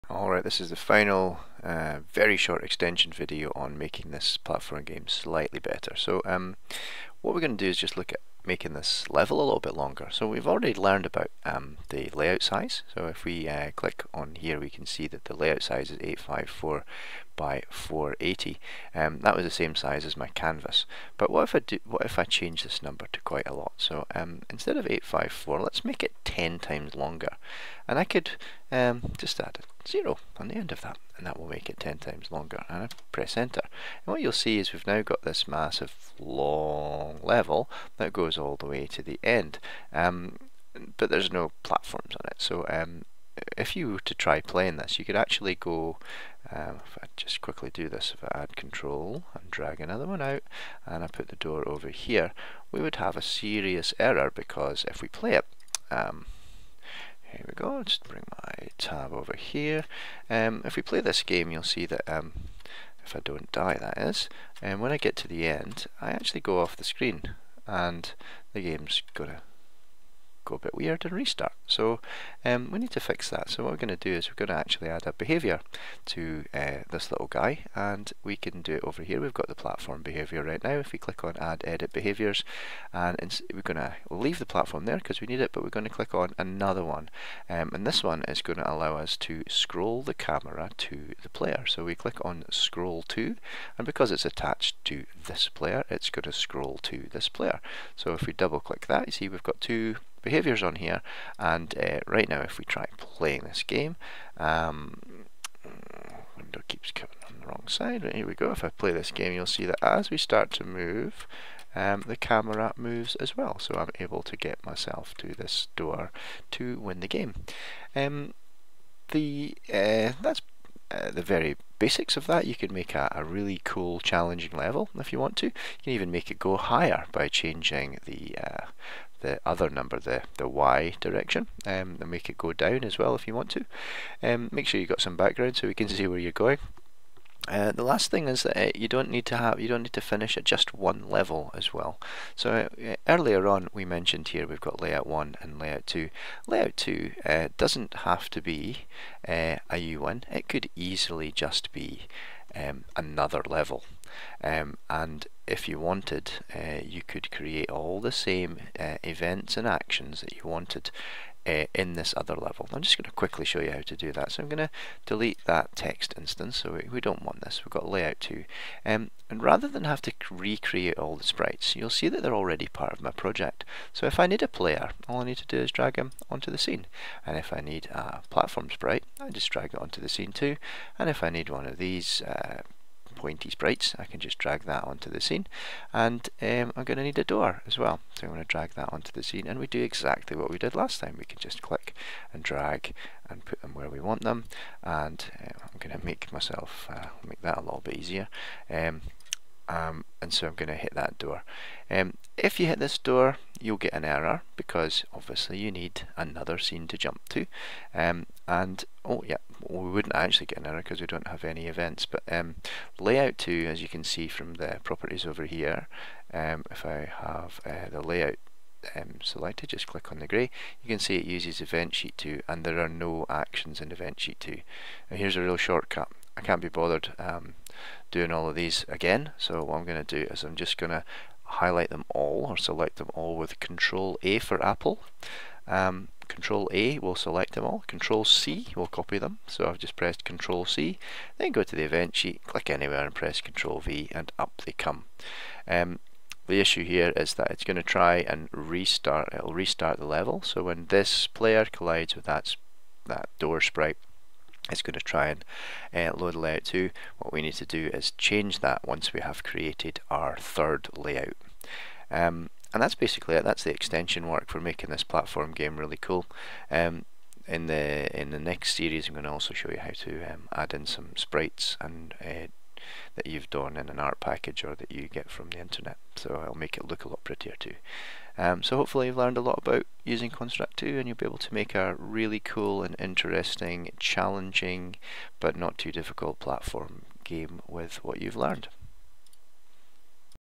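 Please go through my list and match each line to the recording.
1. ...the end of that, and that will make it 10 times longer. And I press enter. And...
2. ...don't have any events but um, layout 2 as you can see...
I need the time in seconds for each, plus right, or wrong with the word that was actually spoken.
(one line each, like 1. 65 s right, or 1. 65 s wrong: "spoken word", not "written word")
1. 30 s right
2. 211 s right.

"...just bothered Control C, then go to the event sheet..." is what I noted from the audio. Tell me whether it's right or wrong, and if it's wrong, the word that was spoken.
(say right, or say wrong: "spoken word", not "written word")
wrong: "pressed", not "bothered".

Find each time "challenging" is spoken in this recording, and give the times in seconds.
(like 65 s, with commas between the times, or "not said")
124 s, 283 s.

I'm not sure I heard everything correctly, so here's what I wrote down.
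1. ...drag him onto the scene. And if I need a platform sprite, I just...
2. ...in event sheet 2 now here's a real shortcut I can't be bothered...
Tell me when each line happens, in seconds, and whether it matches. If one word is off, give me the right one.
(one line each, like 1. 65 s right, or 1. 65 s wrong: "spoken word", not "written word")
1. 175 s right
2. 223 s right.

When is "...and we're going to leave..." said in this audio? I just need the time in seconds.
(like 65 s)
82 s.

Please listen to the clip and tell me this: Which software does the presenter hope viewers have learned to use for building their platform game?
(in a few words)
Construct 2.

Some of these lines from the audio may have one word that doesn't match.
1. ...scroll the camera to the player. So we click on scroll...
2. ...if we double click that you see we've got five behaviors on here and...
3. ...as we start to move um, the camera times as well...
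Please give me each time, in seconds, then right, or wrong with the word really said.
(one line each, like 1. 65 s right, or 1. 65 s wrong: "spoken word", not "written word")
1. 89 s right
2. 98 s wrong: "two", not "five"
3. 109 s wrong: "moves", not "times".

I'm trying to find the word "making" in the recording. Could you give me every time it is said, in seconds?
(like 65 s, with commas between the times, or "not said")
3 s, 8 s, 264 s.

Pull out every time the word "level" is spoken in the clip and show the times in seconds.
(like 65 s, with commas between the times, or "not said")
9 s, 37 s, 124 s, 141 s, 153 s, 162 s, 250 s.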